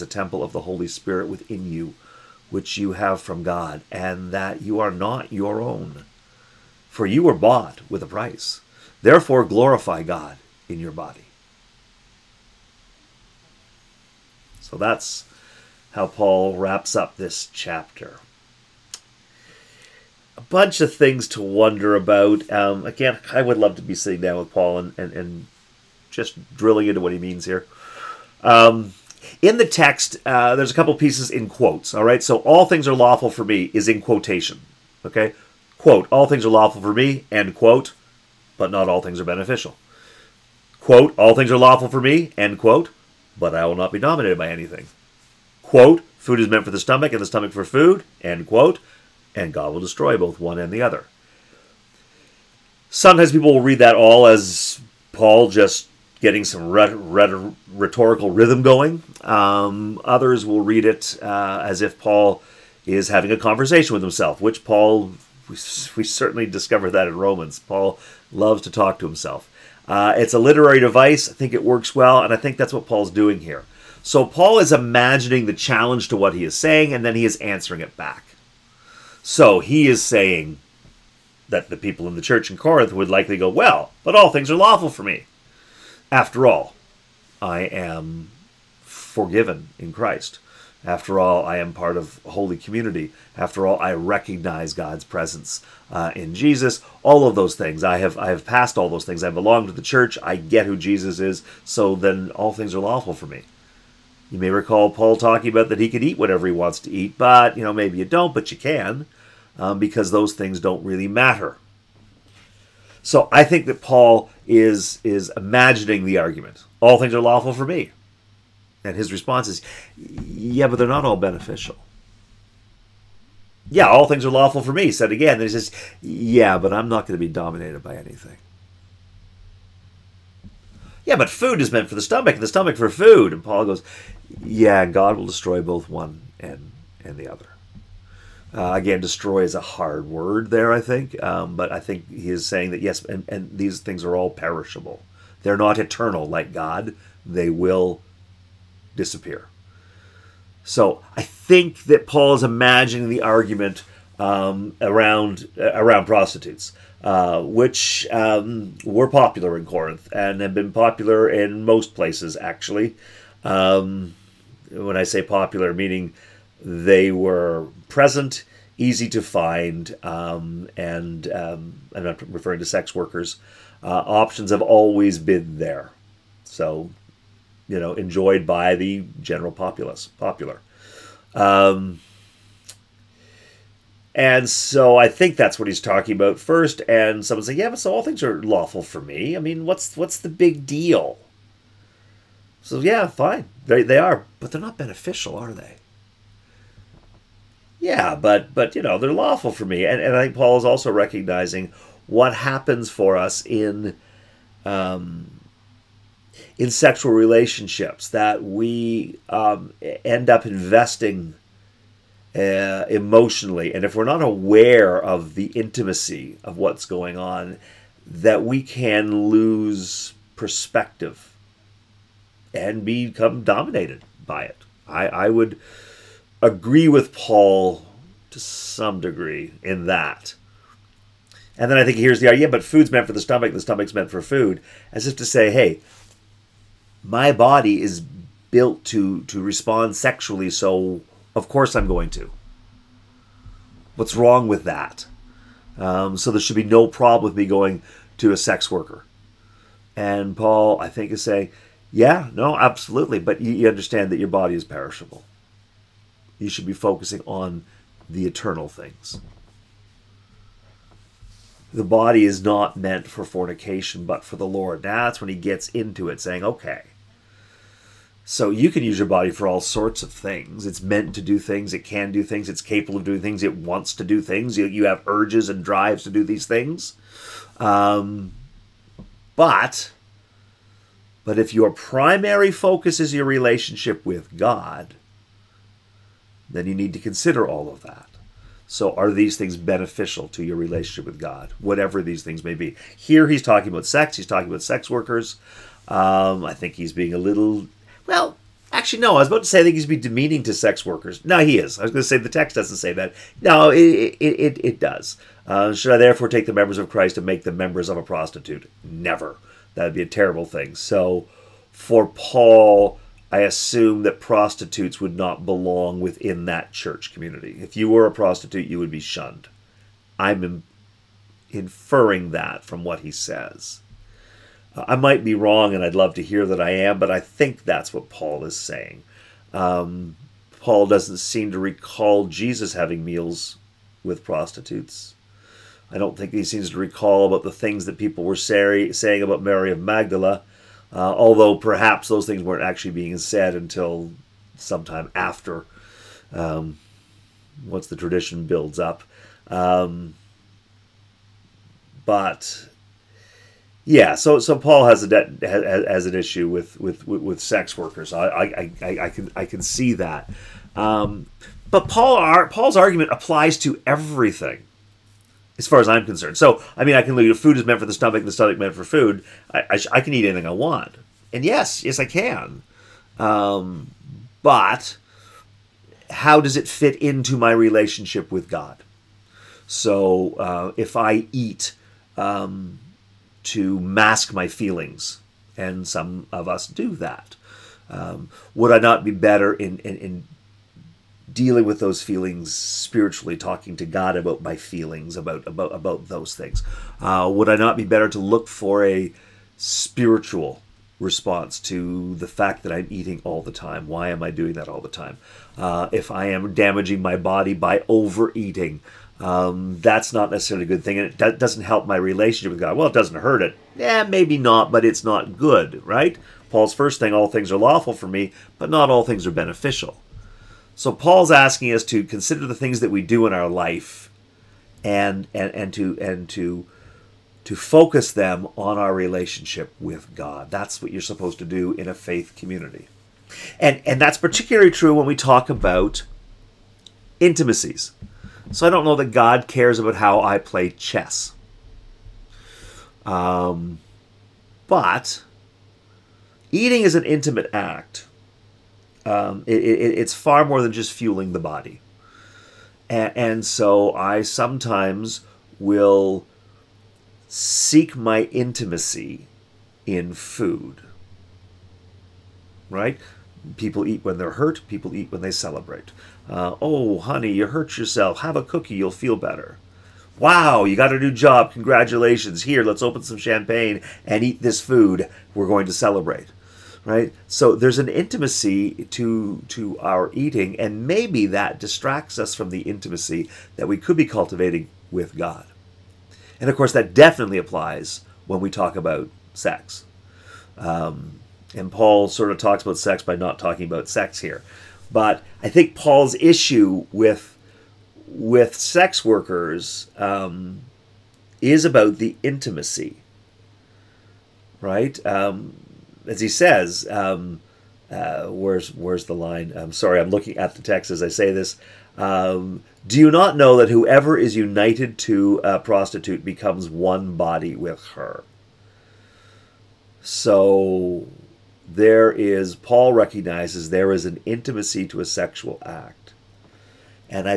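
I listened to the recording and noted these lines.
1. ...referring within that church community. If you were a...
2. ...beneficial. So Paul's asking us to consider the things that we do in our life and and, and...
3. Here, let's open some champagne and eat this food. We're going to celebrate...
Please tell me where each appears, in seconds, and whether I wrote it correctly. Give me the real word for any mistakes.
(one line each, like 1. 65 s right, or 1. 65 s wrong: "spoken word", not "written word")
1. 315 s wrong: "belong", not "referring"
2. 419 s right
3. 472 s right.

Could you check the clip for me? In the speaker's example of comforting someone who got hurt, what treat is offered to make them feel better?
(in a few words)
A cookie.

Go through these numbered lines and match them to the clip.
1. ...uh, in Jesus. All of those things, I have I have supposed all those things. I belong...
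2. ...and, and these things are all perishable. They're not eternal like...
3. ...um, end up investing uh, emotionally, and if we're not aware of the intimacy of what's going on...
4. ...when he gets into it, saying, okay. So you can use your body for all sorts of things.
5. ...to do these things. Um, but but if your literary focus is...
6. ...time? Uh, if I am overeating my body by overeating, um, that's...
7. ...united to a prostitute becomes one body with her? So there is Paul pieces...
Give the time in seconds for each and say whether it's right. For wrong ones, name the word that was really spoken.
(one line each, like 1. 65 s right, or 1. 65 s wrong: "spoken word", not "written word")
1. 95 s wrong: "passed", not "supposed"
2. 143 s right
3. 209 s right
4. 265 s right
5. 276 s wrong: "primary", not "literary"
6. 404 s wrong: "damaging", not "overeating"
7. 514 s wrong: "recognizes", not "pieces".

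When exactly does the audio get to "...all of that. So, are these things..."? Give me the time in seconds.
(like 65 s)
287 s.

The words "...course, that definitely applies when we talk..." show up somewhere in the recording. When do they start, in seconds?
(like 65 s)
486 s.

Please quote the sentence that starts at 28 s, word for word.
Um, in the text, uh, there's a couple pieces in quotes, all right?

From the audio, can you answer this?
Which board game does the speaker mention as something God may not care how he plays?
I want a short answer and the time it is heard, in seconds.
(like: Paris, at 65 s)
Chess, at 440 s.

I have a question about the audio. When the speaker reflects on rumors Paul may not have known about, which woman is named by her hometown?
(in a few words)
Mary of Magdala.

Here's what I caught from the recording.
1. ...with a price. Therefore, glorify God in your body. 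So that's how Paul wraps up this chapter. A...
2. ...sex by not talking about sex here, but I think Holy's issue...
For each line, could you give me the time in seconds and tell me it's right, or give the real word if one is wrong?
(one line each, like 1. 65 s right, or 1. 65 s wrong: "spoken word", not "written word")
1. 7 s right
2. 492 s wrong: "Paul", not "Holy".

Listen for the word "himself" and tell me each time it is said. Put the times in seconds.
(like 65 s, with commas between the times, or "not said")
64 s, 69 s.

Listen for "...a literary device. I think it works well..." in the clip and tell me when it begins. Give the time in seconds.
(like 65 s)
70 s.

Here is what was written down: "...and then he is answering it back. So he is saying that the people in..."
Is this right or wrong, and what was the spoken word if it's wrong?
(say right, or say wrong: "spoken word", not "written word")
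right.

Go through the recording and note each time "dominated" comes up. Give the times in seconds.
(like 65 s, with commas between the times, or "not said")
43 s, 127 s, 223 s.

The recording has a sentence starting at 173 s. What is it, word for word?
Uh, options have always been there, so you know enjoyed by the general populace.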